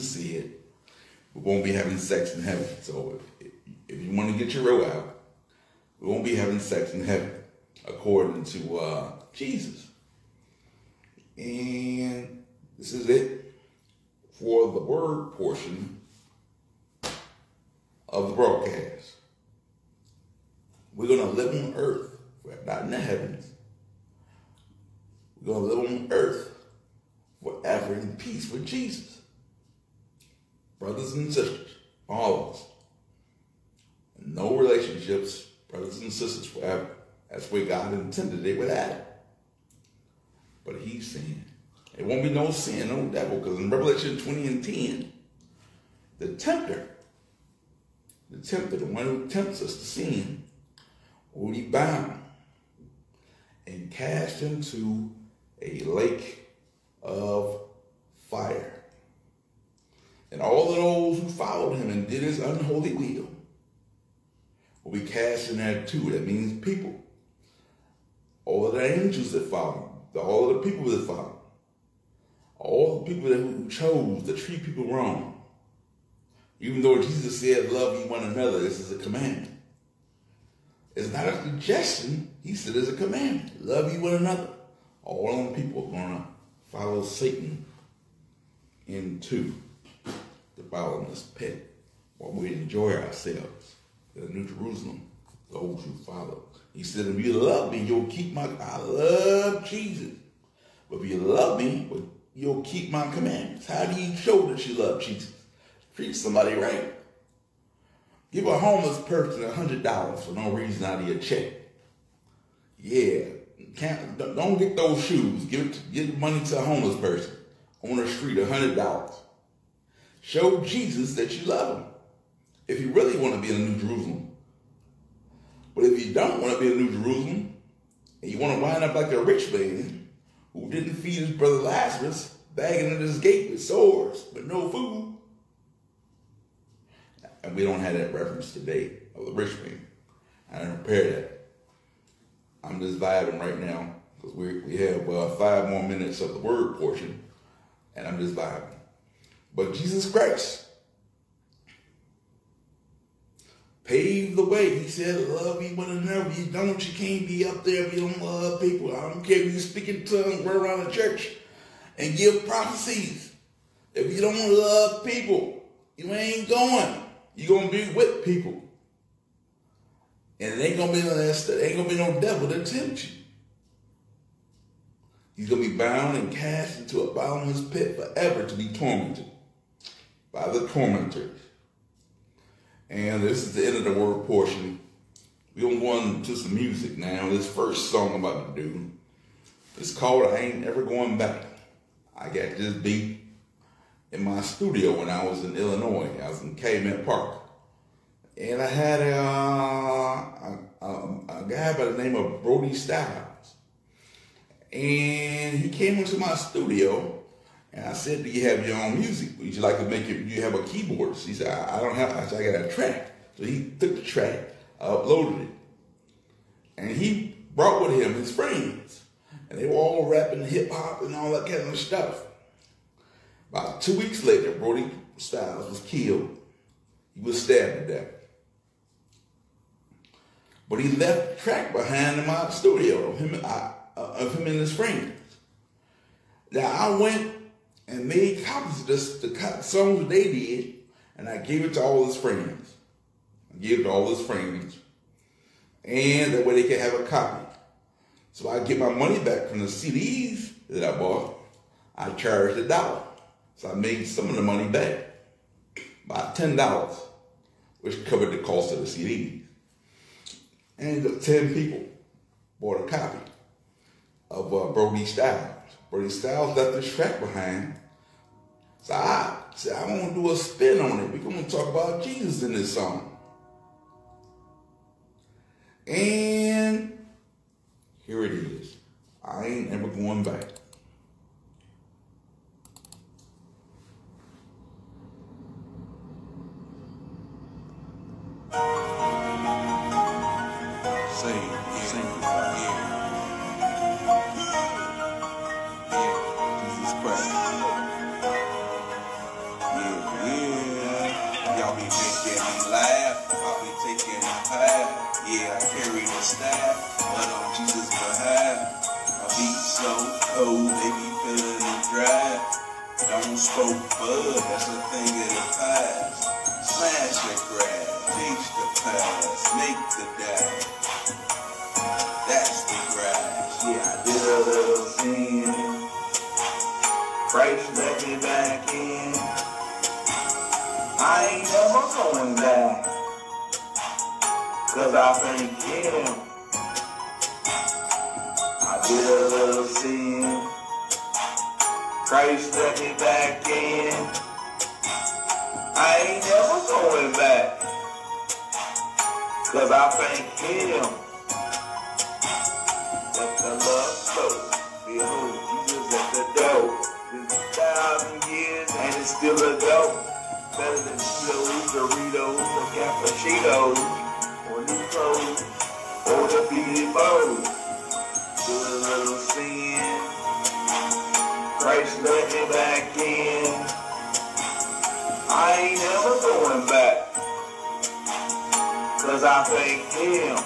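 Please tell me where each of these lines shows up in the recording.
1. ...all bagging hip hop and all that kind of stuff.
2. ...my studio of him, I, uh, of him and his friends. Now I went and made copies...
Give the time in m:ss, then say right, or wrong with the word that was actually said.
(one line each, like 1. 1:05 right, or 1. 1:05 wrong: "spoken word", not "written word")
1. 3:39 wrong: "rapping", not "bagging"
2. 3:52 right.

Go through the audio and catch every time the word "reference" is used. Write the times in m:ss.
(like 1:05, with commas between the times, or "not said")
2:18.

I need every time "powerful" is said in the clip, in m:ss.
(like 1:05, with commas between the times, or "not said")
not said.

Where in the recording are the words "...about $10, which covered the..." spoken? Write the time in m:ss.
4:16.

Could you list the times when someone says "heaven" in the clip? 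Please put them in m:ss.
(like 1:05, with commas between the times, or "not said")
0:02, 0:07, 0:22.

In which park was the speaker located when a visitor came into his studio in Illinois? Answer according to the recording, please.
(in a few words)
Cayman Park.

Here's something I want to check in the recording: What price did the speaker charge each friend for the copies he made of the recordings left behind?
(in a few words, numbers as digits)
$1.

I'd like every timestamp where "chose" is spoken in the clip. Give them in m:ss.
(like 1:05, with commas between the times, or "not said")
1:13.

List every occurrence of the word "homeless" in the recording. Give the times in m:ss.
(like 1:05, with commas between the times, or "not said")
1:48, 1:56.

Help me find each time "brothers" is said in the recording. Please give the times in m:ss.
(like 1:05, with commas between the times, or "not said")
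0:30, 0:35, 2:11.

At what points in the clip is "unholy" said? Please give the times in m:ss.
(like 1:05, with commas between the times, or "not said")
1:02.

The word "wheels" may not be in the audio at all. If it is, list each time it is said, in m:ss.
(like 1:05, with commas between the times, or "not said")
not said.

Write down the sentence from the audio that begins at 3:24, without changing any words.
And he came into my studio and I said, Do you have your own music?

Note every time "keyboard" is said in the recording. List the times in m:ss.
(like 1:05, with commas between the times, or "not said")
3:30.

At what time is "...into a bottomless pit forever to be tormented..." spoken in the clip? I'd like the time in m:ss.
2:56.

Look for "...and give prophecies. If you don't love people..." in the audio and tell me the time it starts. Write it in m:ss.
2:41.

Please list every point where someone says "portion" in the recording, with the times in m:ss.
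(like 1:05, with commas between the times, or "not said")
0:15, 2:26, 3:04.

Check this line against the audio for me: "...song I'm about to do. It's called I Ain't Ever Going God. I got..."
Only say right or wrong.
wrong.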